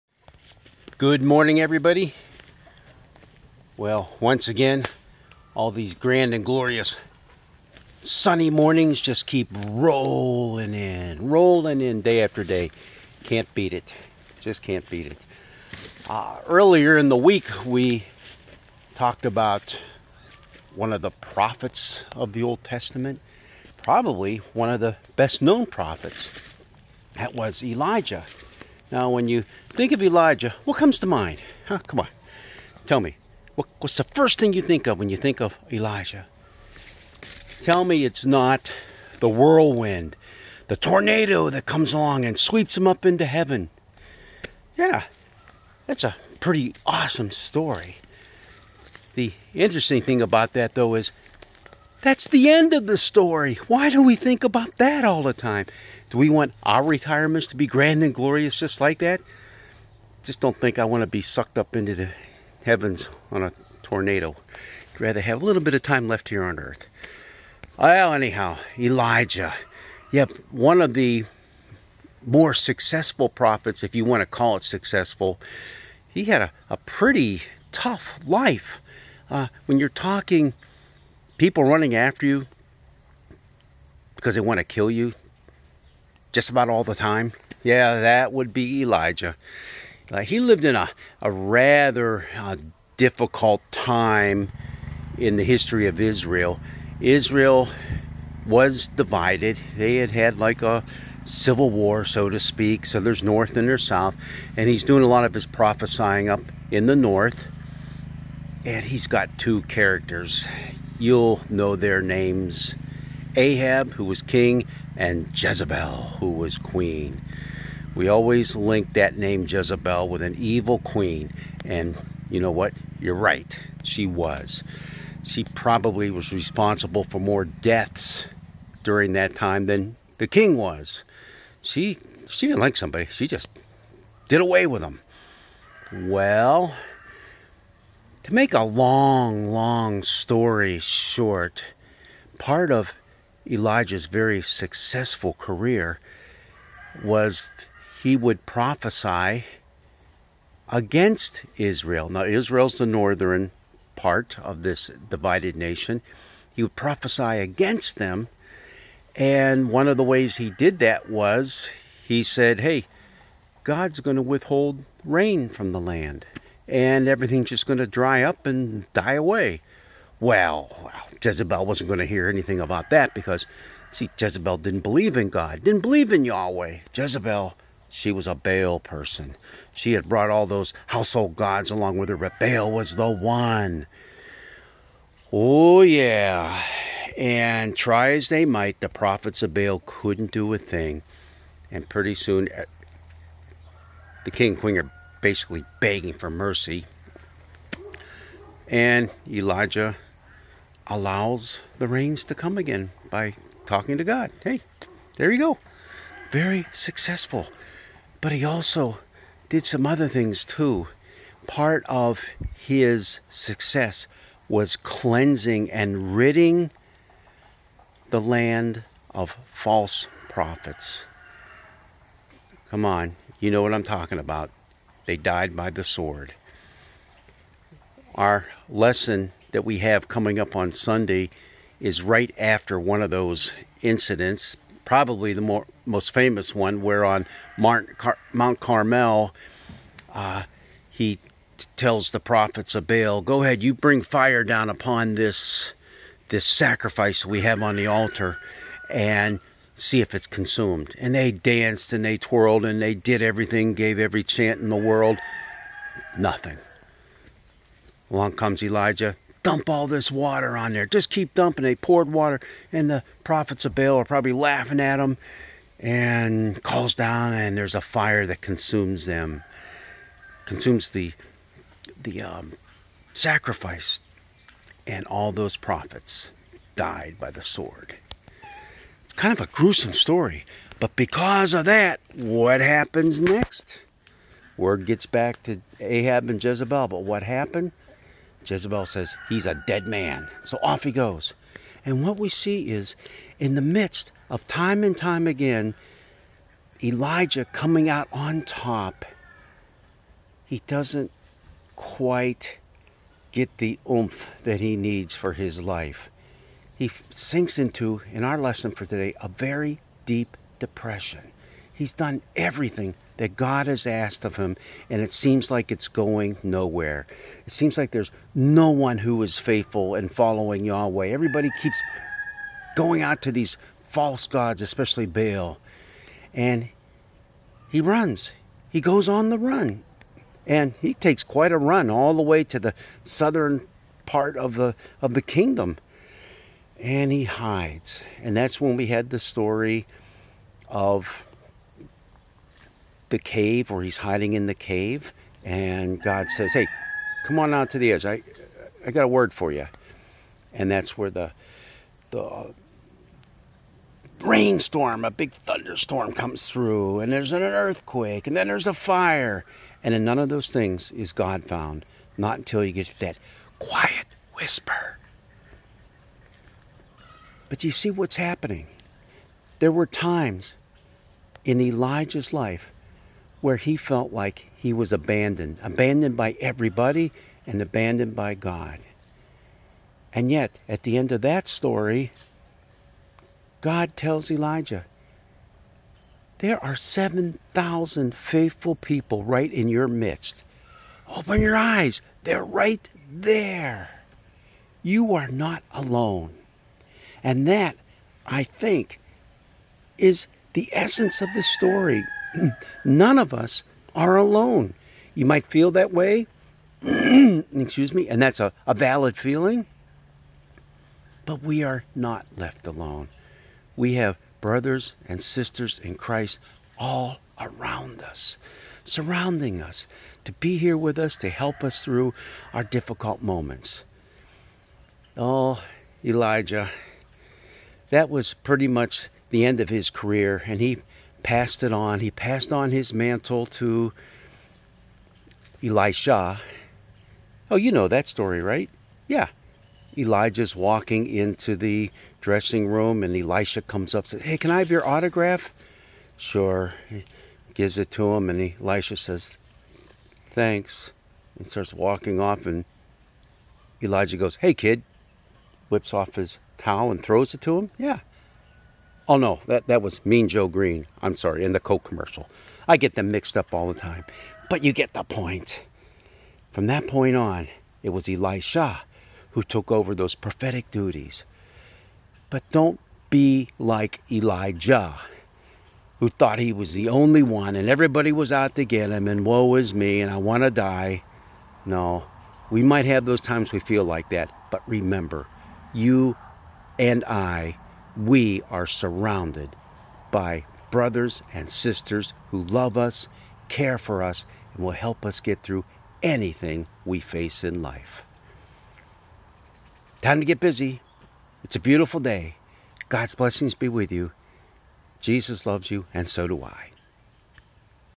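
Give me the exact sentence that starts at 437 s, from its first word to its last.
Oh, you know that story, right?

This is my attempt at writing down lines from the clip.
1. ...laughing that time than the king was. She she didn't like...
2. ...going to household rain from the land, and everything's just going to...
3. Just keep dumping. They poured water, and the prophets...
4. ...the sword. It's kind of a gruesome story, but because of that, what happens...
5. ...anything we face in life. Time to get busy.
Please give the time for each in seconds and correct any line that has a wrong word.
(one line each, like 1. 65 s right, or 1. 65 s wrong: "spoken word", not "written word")
1. 128 s wrong: "during", not "laughing"
2. 163 s wrong: "withhold", not "household"
3. 260 s right
4. 277 s right
5. 496 s right.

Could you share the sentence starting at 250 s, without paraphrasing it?
And they danced and they twirled and they did everything, gave every chant in the world.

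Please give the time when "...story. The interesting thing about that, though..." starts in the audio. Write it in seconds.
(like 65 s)
47 s.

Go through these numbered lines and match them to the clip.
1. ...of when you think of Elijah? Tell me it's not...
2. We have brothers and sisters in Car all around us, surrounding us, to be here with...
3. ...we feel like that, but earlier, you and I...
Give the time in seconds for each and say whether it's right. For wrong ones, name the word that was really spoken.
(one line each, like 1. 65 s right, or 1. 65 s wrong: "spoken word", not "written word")
1. 34 s right
2. 413 s wrong: "Christ", not "Car"
3. 483 s wrong: "remember", not "earlier".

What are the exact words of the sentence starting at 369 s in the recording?
There were times in Elijah's life where he felt like he was abandoned, abandoned by everybody and abandoned by God.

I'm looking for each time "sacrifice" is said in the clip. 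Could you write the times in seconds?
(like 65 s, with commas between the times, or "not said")
246 s, 273 s.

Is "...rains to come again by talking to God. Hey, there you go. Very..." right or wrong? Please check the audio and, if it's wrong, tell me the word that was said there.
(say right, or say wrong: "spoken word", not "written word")
right.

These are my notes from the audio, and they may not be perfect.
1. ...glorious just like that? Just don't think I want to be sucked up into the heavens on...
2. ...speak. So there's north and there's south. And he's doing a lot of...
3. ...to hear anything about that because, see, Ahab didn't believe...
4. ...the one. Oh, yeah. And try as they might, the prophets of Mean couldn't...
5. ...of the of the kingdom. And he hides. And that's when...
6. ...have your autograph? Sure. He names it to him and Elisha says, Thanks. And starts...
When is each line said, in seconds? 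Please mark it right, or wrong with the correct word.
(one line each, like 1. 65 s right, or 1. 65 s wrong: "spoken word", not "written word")
1. 58 s right
2. 102 s right
3. 171 s wrong: "Jezebel", not "Ahab"
4. 182 s wrong: "Baal", not "Mean"
5. 334 s right
6. 444 s wrong: "gives", not "names".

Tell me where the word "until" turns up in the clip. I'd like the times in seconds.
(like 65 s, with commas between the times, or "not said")
362 s.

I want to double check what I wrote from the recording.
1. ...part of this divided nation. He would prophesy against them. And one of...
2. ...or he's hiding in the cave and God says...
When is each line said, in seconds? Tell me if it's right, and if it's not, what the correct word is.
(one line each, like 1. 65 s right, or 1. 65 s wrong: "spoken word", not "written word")
1. 153 s right
2. 343 s right.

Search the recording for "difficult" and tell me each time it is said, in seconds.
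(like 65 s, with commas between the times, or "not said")
92 s, 422 s.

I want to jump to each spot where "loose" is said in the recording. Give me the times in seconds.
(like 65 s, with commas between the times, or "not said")
not said.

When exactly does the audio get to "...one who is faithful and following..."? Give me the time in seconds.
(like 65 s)
318 s.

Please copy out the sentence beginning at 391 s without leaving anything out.
Open your eyes, they're right there.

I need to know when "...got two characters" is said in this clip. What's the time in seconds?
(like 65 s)
109 s.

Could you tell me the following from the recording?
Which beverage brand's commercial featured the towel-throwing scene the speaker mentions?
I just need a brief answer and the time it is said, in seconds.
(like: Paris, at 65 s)
Coke, at 461 s.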